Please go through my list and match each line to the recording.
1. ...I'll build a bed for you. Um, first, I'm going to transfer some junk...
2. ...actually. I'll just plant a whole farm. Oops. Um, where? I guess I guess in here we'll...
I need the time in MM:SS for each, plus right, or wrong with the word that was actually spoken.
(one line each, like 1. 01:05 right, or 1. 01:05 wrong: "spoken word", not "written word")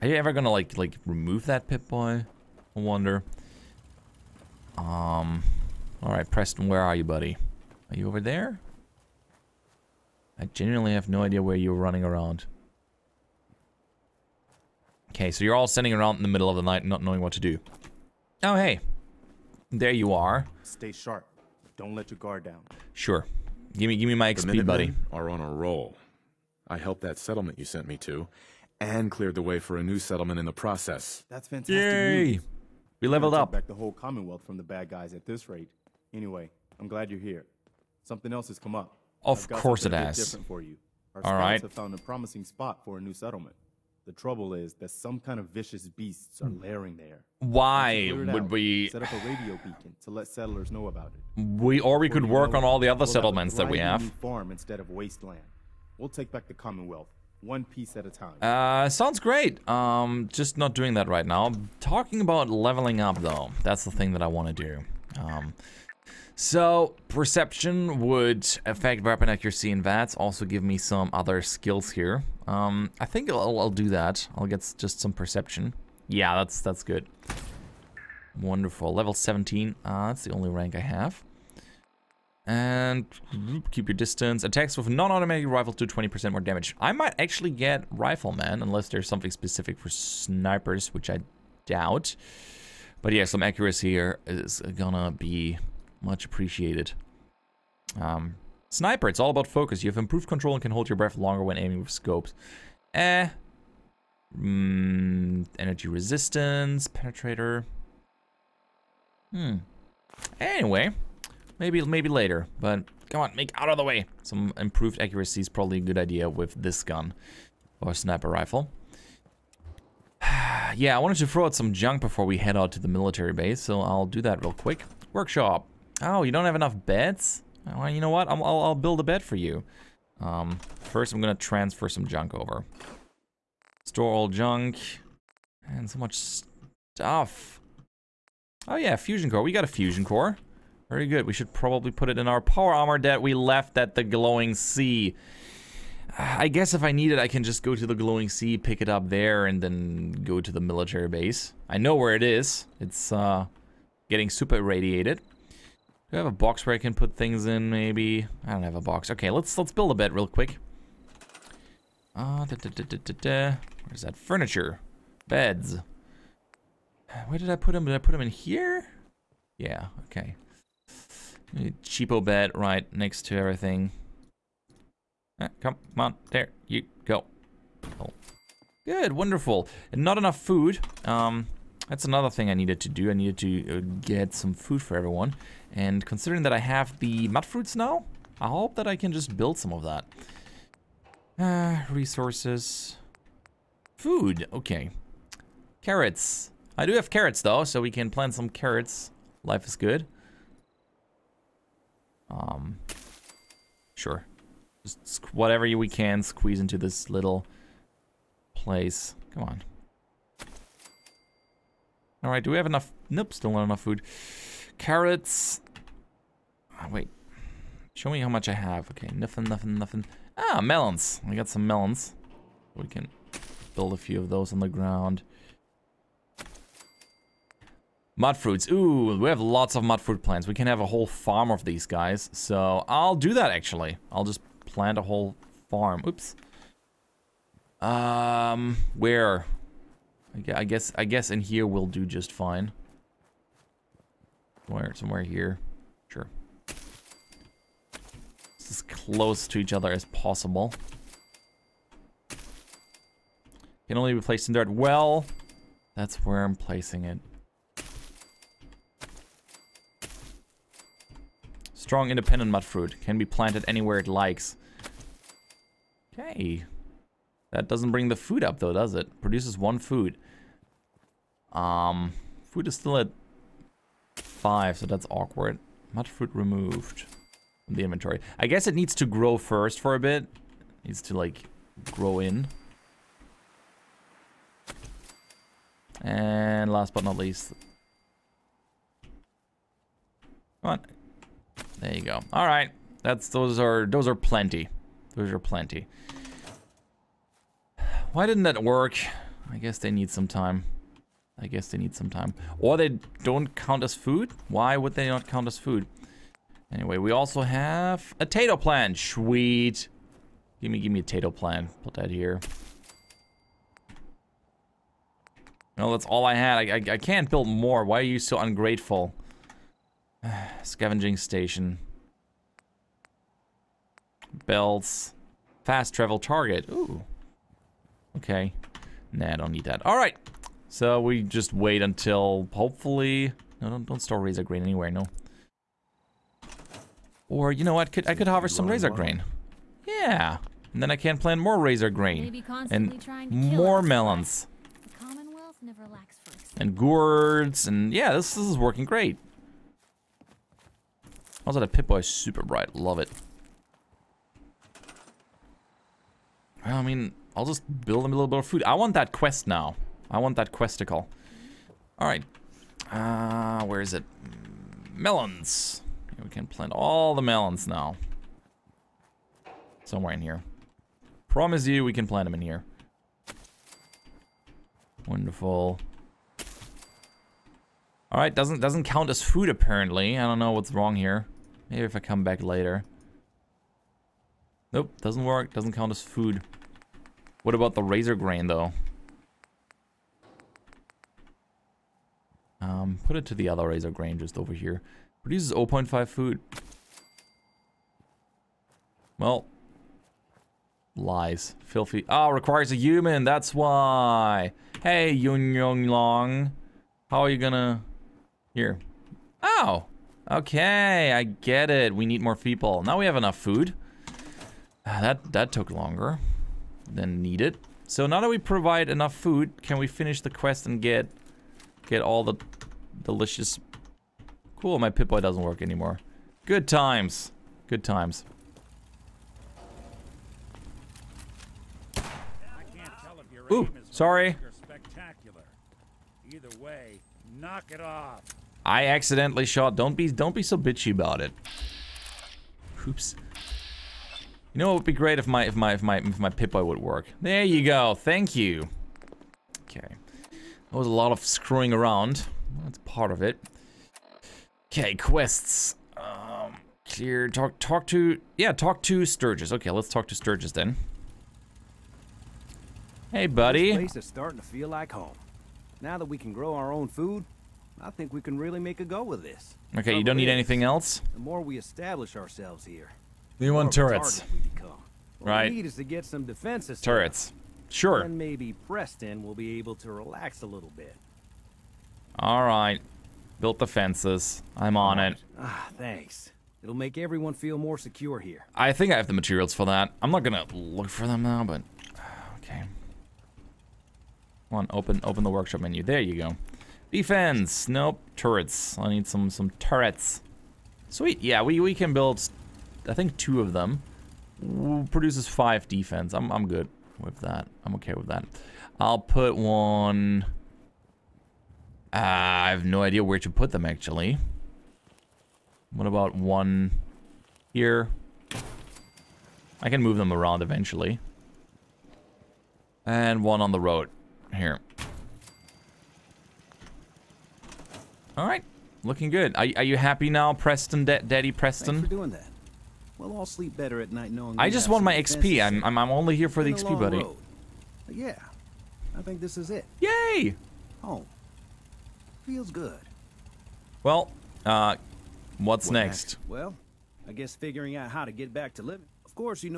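1. 02:08 right
2. 03:53 right.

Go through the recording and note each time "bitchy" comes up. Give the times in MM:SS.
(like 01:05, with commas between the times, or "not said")
07:20.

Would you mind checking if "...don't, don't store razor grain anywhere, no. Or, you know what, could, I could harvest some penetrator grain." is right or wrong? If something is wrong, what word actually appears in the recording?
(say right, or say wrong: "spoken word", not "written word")
wrong: "razor", not "penetrator".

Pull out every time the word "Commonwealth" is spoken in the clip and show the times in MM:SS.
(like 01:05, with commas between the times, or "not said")
00:33, 00:56.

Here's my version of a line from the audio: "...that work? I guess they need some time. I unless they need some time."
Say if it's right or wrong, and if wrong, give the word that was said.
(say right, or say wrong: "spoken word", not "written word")
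wrong: "guess", not "unless".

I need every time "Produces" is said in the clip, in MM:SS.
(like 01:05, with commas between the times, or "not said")
04:29, 06:35, 08:24.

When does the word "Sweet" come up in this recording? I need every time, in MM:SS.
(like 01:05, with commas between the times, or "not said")
05:08, 08:20.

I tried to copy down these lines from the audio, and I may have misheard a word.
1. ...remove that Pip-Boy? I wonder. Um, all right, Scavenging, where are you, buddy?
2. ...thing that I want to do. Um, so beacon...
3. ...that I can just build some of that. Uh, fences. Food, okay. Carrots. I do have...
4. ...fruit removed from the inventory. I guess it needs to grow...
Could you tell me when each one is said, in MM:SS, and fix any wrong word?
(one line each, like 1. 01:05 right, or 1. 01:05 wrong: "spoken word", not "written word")
1. 00:01 wrong: "Preston", not "Scavenging"
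2. 01:03 wrong: "perception", not "beacon"
3. 03:08 wrong: "resources", not "fences"
4. 04:36 right.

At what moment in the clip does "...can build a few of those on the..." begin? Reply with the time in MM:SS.
03:42.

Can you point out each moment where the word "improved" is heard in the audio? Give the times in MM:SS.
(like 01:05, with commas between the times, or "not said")
01:39, 01:54.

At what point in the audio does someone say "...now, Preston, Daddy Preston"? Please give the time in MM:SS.
08:50.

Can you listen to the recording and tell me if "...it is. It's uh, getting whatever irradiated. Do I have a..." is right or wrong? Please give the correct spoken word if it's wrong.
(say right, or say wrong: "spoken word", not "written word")
wrong: "super", not "whatever".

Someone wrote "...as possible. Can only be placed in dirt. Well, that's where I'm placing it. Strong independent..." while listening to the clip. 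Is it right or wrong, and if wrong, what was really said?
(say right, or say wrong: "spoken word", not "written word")
right.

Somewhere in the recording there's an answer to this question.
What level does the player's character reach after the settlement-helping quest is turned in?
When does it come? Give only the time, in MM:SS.
01:18.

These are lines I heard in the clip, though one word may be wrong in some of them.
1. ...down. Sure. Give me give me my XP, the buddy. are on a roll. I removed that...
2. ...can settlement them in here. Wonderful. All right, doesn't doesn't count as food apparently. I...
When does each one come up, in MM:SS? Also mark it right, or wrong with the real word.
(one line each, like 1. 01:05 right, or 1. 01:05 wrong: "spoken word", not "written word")
1. 00:22 wrong: "helped", not "removed"
2. 06:11 wrong: "plant", not "settlement".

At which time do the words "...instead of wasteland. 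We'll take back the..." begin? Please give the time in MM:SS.
00:54.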